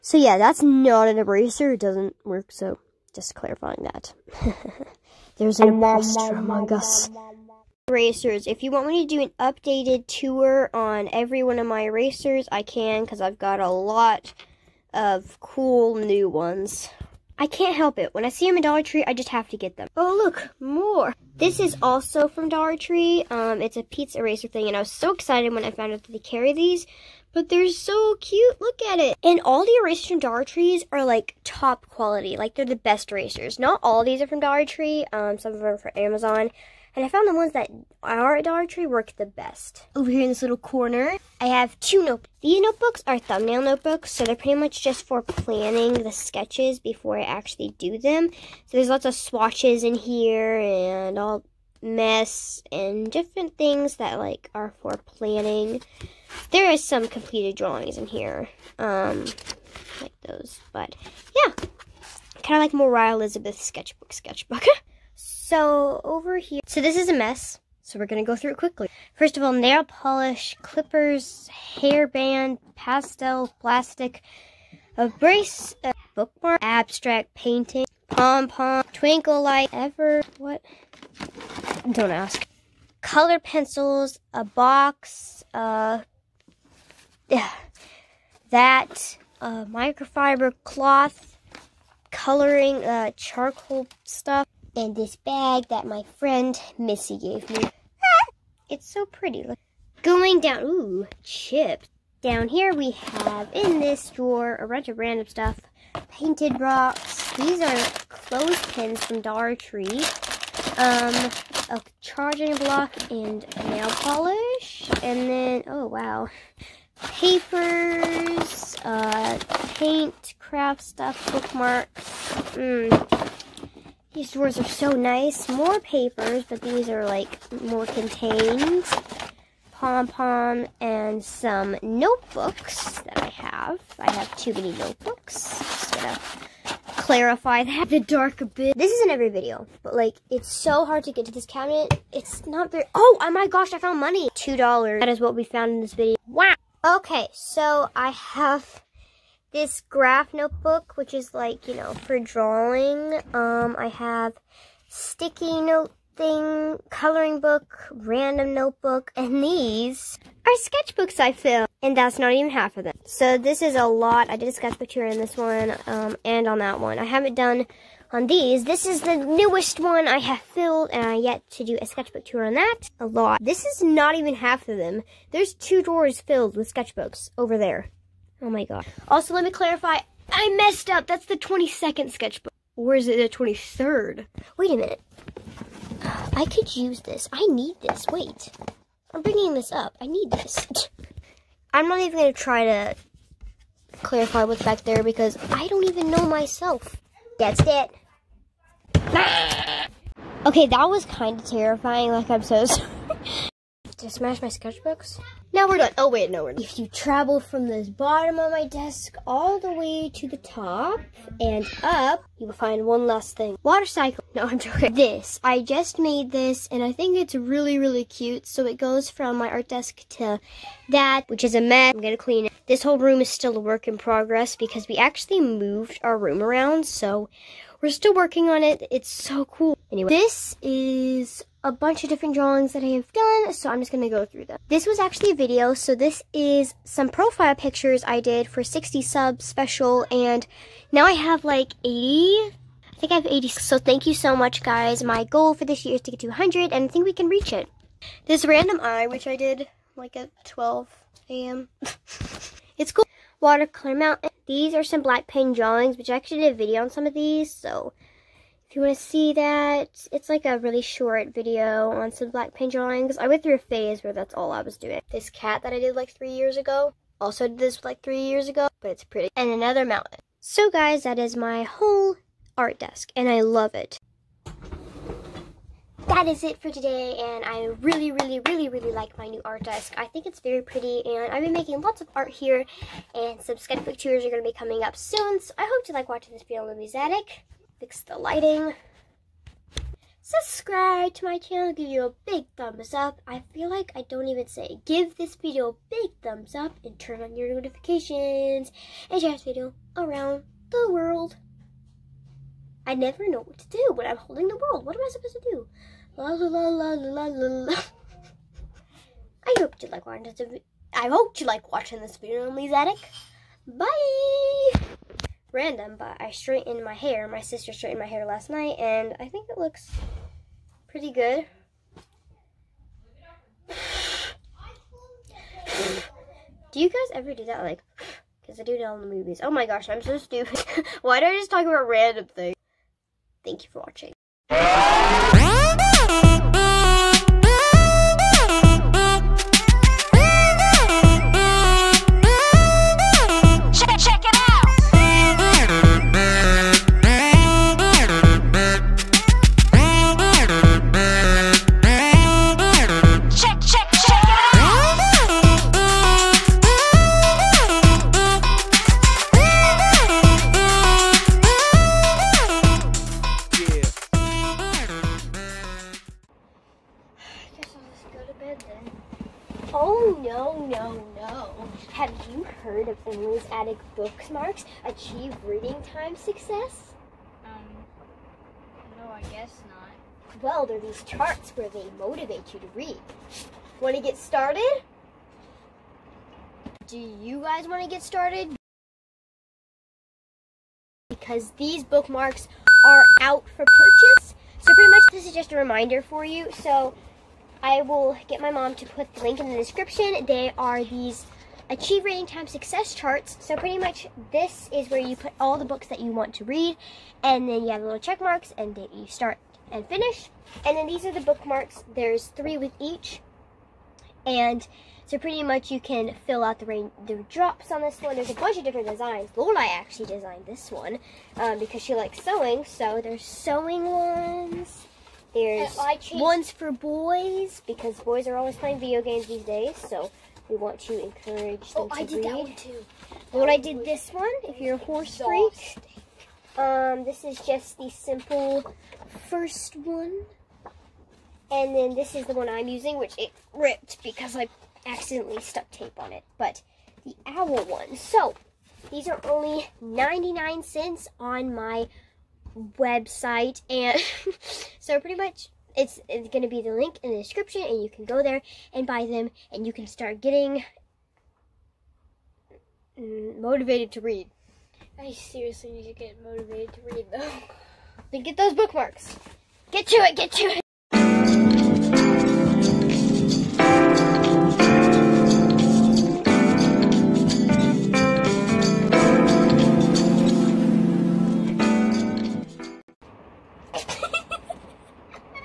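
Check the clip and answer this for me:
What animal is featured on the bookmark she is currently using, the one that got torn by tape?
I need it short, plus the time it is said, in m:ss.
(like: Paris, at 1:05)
Owl, at 7:27.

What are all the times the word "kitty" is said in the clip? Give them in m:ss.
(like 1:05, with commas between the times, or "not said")
not said.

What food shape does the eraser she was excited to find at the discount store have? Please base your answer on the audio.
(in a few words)
Pizza.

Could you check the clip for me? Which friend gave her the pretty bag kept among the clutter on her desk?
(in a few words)
Missy.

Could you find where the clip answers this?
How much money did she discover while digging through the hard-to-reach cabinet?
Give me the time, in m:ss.
2:24.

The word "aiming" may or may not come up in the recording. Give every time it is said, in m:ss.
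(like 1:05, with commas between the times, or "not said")
not said.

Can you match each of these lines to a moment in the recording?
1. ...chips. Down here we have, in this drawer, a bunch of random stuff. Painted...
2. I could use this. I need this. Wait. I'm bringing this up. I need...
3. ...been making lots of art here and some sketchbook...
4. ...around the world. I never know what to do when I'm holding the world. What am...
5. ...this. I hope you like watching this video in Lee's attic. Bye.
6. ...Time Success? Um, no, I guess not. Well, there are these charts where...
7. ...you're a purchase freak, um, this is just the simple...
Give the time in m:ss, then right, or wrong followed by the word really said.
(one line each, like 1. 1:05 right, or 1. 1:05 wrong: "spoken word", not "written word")
1. 1:41 right
2. 3:06 right
3. 4:41 right
4. 4:59 right
5. 5:10 right
6. 6:15 right
7. 7:14 wrong: "horse", not "purchase".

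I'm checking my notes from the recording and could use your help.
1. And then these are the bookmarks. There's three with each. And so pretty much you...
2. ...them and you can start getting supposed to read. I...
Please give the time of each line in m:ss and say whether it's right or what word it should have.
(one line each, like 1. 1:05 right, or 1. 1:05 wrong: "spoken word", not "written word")
1. 6:50 right
2. 7:39 wrong: "motivated", not "supposed".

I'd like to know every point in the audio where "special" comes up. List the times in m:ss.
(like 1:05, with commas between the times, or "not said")
3:59.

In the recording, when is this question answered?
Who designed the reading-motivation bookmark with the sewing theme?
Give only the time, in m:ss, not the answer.
6:59.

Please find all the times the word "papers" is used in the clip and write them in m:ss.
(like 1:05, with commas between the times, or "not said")
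1:57, 2:05.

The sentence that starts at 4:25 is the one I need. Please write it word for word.
This cat that I did like three years ago, also did this like three years ago, but it's pretty.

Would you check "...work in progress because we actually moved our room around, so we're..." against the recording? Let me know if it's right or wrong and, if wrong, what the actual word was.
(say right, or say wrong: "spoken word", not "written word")
right.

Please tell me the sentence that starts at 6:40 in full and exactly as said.
They are these Achieve Reading Time Success charts.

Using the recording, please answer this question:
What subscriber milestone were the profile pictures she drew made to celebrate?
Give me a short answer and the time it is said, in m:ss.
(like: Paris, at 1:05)
60 subs, at 3:58.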